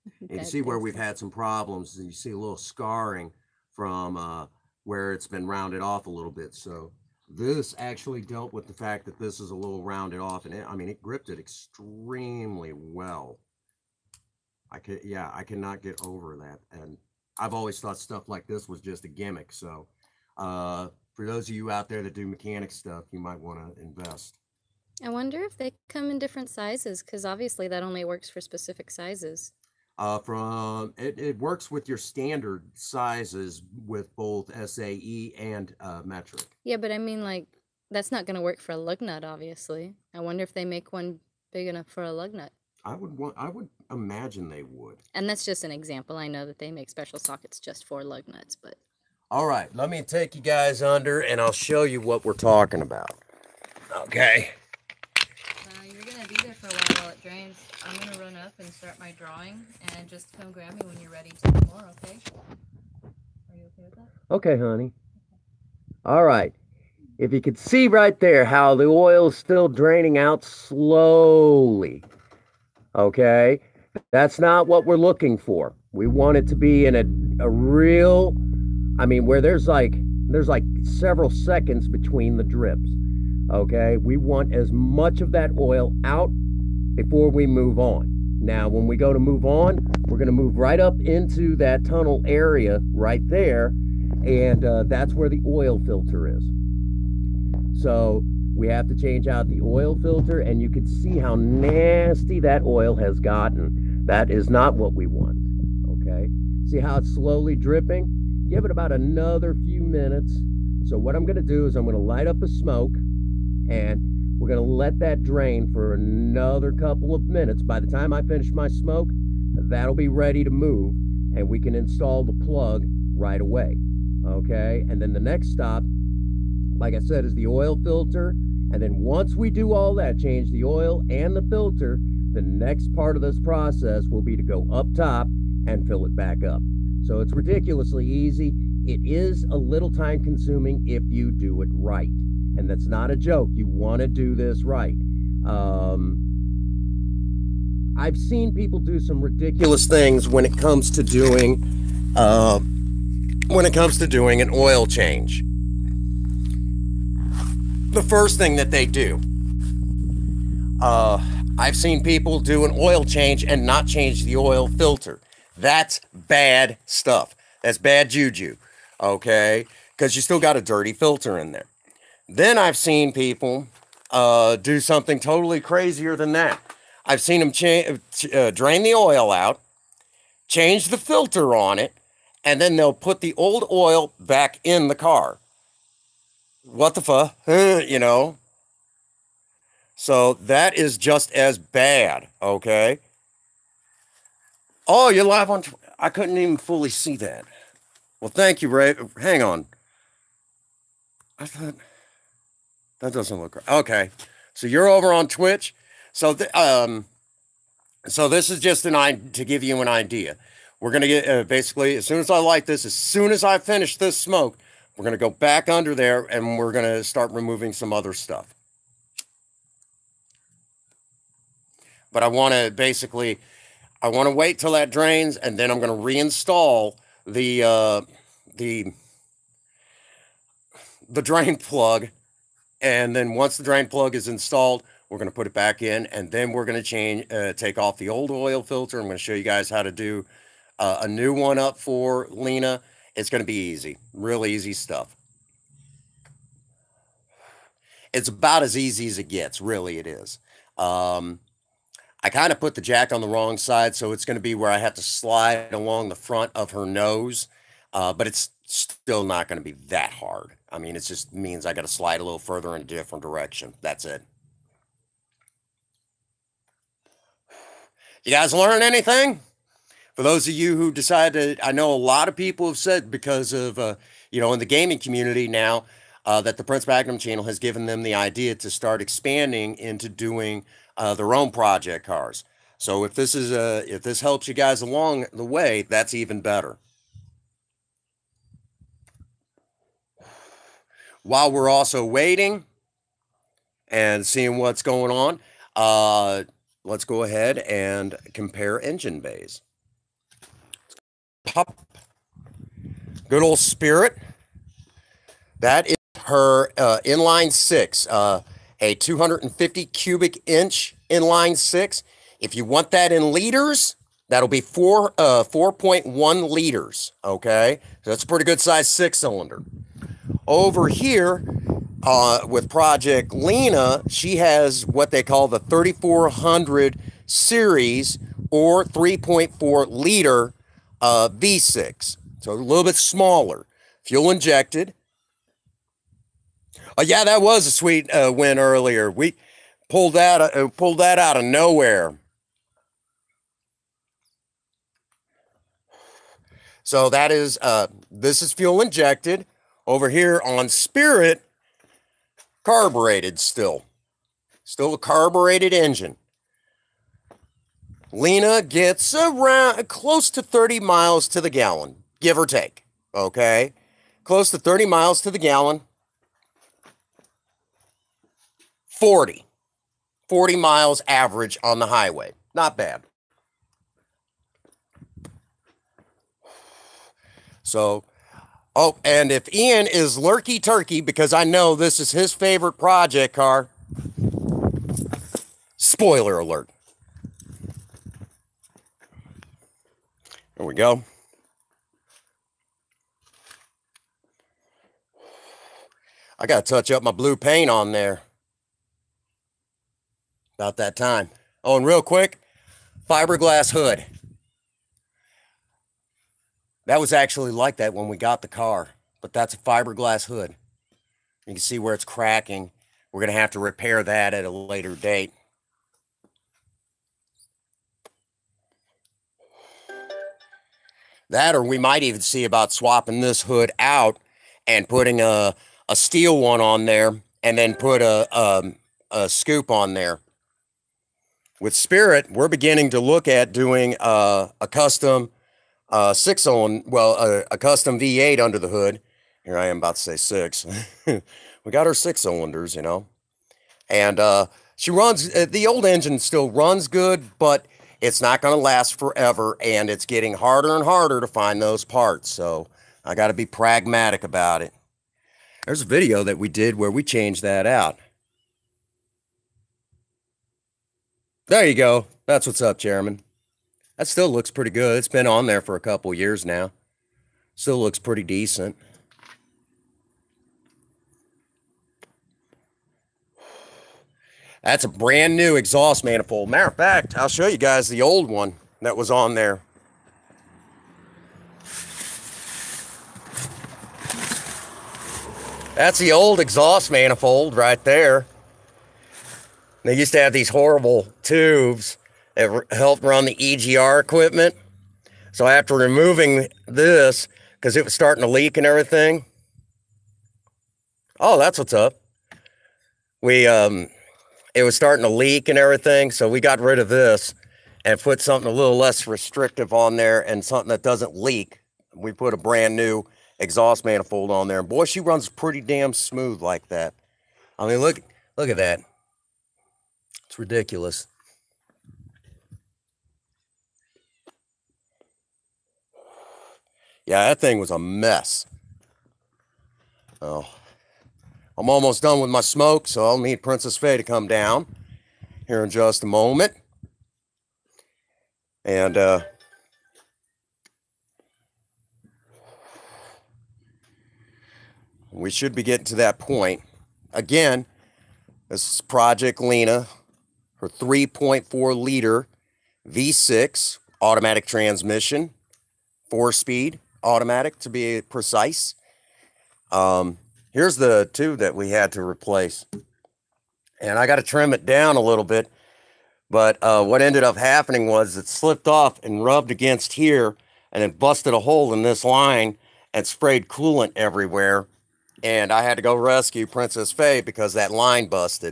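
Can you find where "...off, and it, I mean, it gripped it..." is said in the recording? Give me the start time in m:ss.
0:10.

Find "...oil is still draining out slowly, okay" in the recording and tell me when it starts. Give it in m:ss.
1:08.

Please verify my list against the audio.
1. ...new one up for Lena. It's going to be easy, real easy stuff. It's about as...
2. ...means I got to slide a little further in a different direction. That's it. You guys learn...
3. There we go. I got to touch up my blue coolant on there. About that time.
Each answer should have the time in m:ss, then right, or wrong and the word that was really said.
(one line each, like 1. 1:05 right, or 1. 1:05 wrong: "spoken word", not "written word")
1. 4:01 right
2. 4:21 right
3. 6:30 wrong: "paint", not "coolant".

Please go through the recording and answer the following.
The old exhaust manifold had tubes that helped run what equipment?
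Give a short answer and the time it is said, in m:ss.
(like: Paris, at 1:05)
EGR equipment, at 8:13.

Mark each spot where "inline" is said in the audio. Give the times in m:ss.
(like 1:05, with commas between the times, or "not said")
5:07, 5:11.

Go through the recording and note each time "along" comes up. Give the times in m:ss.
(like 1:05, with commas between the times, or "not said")
4:15, 4:44.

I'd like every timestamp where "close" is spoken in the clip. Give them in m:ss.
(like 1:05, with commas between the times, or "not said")
5:59, 6:04.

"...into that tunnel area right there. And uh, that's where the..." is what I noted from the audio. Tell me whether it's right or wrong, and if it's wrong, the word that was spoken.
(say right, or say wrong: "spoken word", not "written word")
right.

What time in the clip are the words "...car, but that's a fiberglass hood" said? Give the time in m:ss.
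6:48.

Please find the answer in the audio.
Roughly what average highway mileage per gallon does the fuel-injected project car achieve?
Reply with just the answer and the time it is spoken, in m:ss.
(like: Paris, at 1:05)
40 miles, at 6:10.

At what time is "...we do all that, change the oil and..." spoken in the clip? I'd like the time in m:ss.
2:09.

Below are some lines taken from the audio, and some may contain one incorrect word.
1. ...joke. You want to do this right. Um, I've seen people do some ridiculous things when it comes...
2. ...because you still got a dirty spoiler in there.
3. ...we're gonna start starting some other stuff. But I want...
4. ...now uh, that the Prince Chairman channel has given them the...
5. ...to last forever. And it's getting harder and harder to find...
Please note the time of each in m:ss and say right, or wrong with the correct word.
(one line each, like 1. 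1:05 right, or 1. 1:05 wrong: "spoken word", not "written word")
1. 2:23 right
2. 2:49 wrong: "filter", not "spoiler"
3. 3:36 wrong: "removing", not "starting"
4. 4:35 wrong: "Magnum", not "Chairman"
5. 7:28 right.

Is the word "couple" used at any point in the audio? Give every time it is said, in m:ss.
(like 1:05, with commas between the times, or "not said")
1:56, 7:45.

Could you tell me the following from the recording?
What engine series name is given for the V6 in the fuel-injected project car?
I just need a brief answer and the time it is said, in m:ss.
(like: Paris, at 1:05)
3400 series, at 5:25.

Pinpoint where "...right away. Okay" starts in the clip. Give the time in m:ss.
2:03.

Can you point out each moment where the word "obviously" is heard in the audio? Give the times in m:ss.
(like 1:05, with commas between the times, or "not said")
0:27, 0:39.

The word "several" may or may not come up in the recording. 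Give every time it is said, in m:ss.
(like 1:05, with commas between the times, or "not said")
1:20.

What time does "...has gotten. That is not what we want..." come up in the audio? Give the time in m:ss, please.
1:42.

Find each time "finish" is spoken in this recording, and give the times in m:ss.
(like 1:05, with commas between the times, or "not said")
1:58, 3:33.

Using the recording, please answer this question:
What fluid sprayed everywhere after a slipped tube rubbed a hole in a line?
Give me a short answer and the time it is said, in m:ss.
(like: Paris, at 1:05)
Coolant, at 9:33.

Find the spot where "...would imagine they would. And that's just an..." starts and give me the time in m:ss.
0:43.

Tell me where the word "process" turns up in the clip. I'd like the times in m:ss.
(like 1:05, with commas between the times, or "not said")
2:13.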